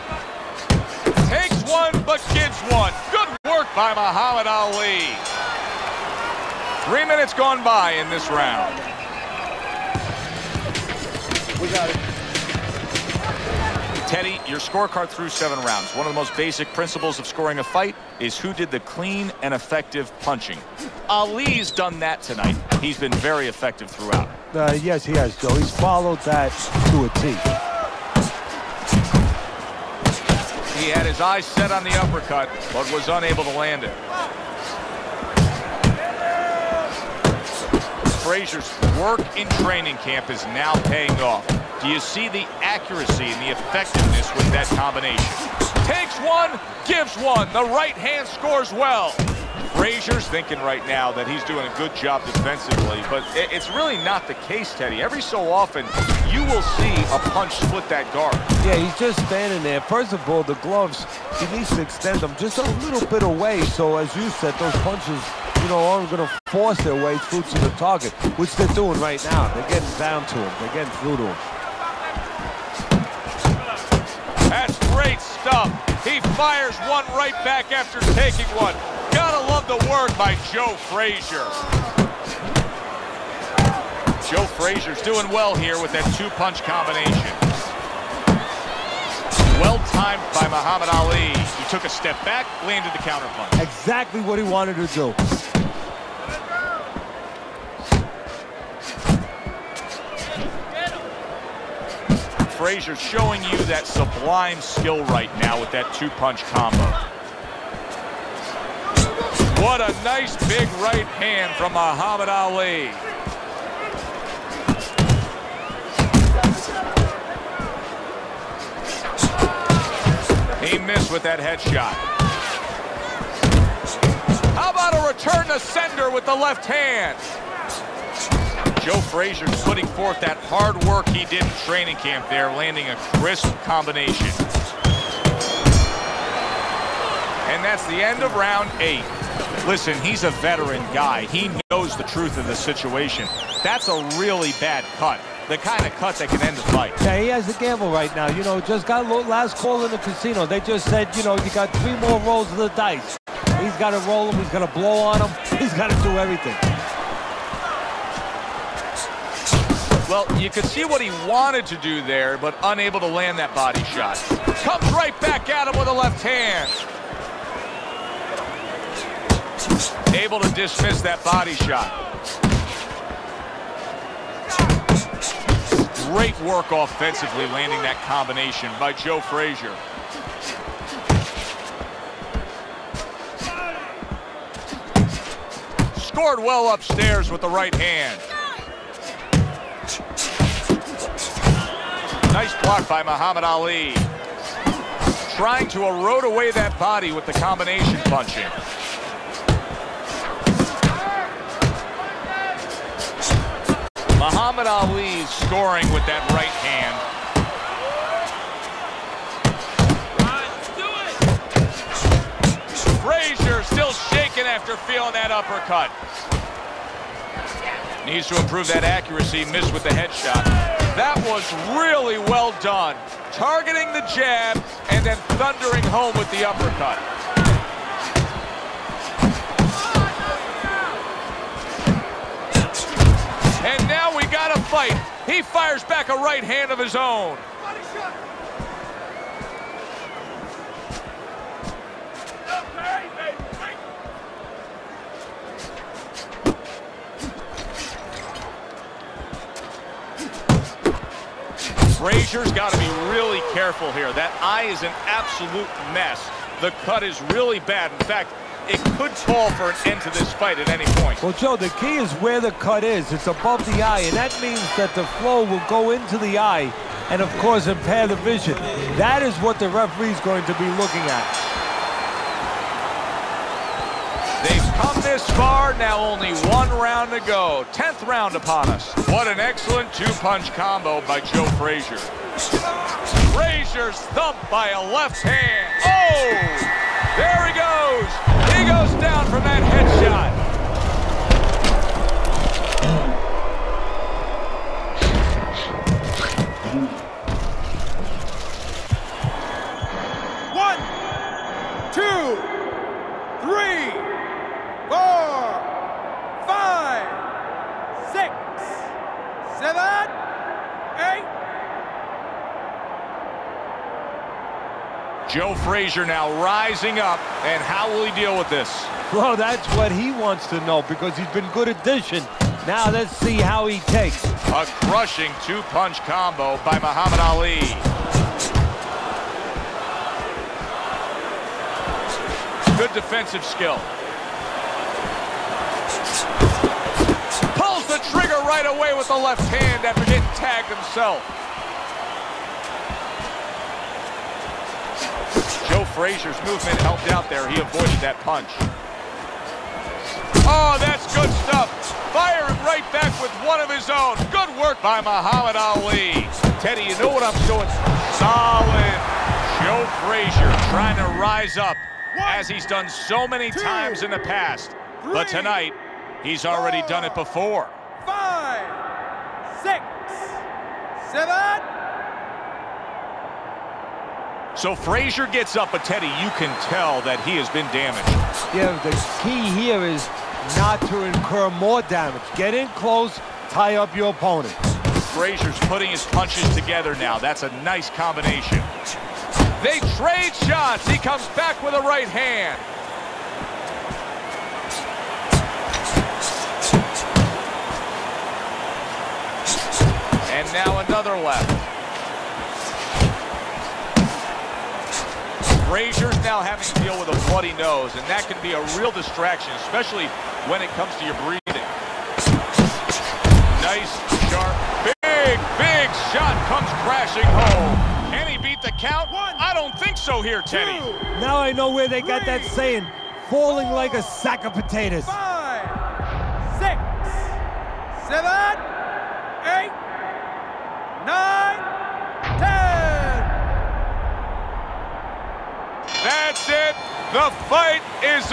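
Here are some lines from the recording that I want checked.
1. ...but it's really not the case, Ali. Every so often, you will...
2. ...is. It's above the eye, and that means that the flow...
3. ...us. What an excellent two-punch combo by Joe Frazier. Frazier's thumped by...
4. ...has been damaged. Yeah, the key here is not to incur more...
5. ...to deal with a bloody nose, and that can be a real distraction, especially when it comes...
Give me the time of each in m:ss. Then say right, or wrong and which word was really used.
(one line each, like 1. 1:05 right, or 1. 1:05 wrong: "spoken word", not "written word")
1. 0:53 wrong: "Teddy", not "Ali"
2. 4:22 right
3. 4:38 right
4. 6:17 right
5. 6:46 right.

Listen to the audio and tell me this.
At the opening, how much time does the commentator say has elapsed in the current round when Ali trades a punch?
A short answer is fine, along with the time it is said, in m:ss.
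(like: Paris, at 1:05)
3 minutes, at 0:06.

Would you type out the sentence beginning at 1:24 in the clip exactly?
Joe Frazier's doing well here with that two-punch combination.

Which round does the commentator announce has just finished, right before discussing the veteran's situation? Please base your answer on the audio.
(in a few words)
Round 8.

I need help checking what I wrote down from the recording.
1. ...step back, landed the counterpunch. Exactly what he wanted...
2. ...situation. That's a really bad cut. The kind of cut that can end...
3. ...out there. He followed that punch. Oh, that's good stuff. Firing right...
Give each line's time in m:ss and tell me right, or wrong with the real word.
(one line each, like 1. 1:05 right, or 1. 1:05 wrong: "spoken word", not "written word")
1. 1:31 right
2. 2:22 right
3. 5:47 wrong: "avoided", not "followed".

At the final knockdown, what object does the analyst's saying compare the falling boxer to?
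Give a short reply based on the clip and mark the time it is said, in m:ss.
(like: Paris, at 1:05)
a sack of potatoes, at 7:04.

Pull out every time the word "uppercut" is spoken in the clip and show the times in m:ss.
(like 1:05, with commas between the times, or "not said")
0:31, 3:35, 3:46.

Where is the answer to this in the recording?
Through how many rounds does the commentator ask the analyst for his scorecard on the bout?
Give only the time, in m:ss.
0:15.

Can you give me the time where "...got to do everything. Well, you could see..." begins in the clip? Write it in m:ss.
2:35.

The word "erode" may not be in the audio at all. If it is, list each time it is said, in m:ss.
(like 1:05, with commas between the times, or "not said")
3:15.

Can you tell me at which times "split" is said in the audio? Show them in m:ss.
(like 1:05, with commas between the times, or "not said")
0:57.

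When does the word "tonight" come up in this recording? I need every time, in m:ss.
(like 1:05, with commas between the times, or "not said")
0:22, 6:05.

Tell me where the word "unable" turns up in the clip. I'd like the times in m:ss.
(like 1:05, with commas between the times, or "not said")
0:33, 2:42.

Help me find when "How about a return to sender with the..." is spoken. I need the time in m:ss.
2:04.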